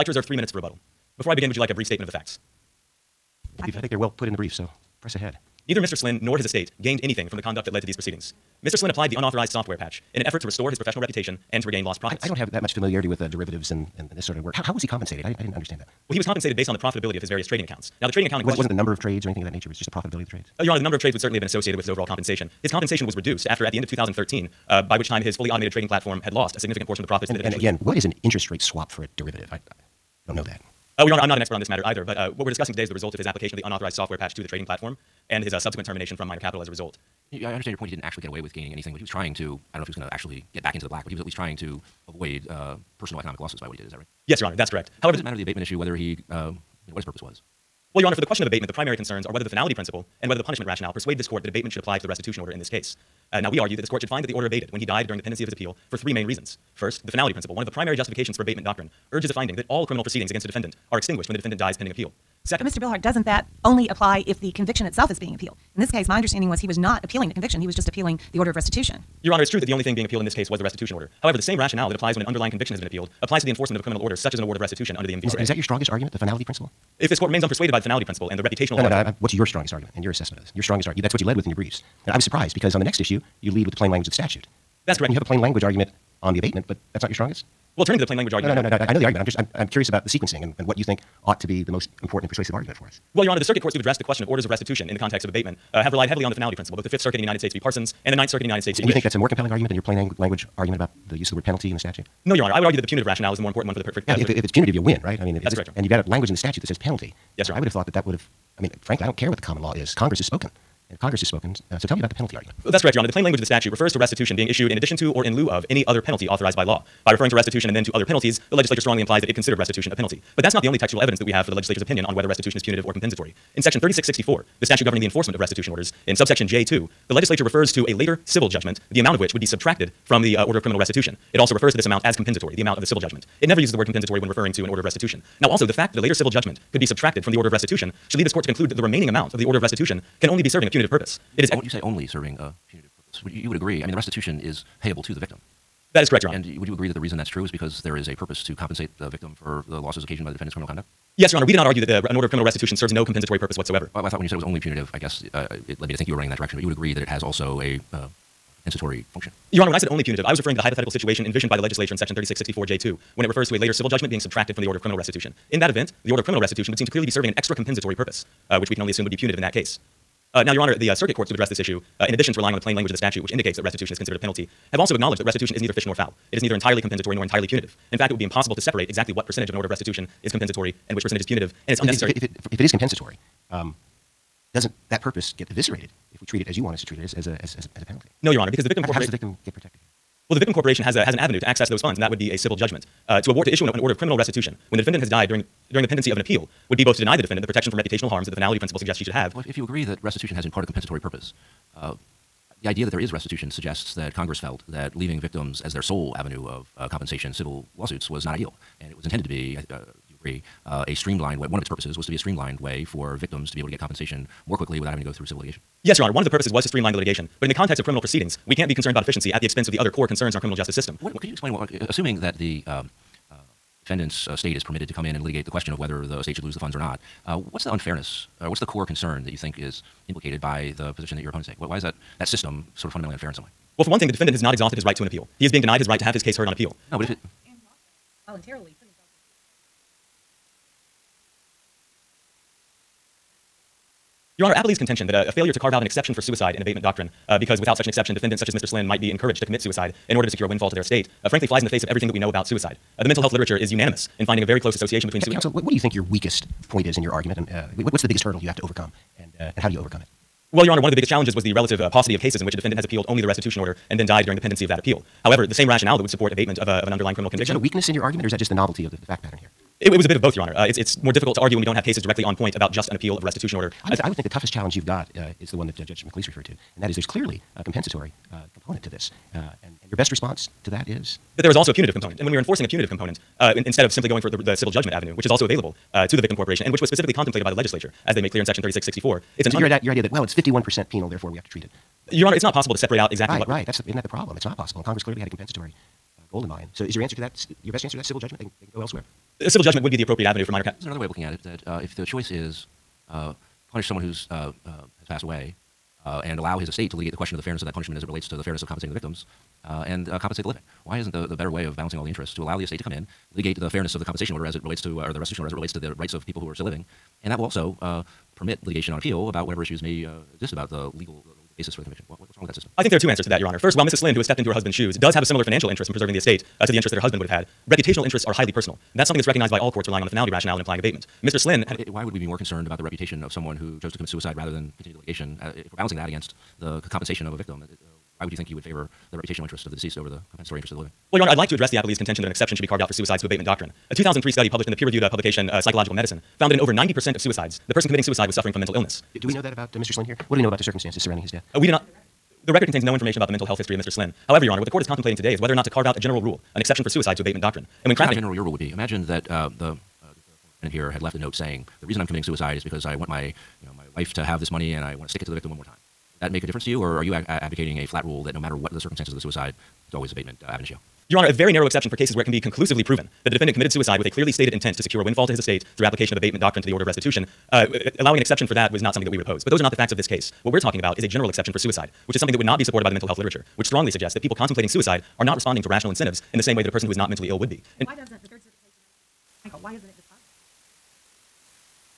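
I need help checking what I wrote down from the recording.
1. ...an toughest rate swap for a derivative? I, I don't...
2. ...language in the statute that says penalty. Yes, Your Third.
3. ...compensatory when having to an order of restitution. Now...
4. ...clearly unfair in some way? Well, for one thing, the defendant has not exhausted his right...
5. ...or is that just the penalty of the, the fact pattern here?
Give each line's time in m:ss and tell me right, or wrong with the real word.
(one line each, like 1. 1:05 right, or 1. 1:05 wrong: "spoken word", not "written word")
1. 0:28 wrong: "interest", not "toughest"
2. 1:46 wrong: "Honor", not "Third"
3. 2:13 wrong: "referring", not "having"
4. 3:52 wrong: "fundamentally", not "clearly"
5. 4:28 wrong: "novelty", not "penalty".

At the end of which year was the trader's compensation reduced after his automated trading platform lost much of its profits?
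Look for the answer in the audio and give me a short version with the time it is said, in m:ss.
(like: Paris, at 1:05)
2013, at 0:23.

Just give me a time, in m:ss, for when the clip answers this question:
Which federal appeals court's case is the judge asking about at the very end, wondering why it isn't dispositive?
6:28.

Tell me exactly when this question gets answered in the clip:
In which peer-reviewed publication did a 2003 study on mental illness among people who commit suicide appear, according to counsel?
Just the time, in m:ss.
5:45.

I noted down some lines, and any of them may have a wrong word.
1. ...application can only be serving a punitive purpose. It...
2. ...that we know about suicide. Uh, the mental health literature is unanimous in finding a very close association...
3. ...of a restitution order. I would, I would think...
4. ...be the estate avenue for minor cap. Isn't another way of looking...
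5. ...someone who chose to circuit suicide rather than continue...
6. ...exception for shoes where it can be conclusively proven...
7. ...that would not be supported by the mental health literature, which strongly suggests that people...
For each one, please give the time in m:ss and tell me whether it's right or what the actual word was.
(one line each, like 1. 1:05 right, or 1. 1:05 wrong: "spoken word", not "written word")
1. 2:19 wrong: "restitution", not "application"
2. 4:12 right
3. 4:33 right
4. 4:59 wrong: "appropriate", not "estate"
5. 5:33 wrong: "commit", not "circuit"
6. 6:11 wrong: "cases", not "shoes"
7. 6:22 right.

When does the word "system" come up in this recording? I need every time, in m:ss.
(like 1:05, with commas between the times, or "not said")
3:40, 3:52, 5:22.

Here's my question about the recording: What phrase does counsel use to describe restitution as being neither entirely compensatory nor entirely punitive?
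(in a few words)
neither fish nor fowl.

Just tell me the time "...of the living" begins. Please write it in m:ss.
5:40.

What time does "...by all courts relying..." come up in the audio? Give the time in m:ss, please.
5:29.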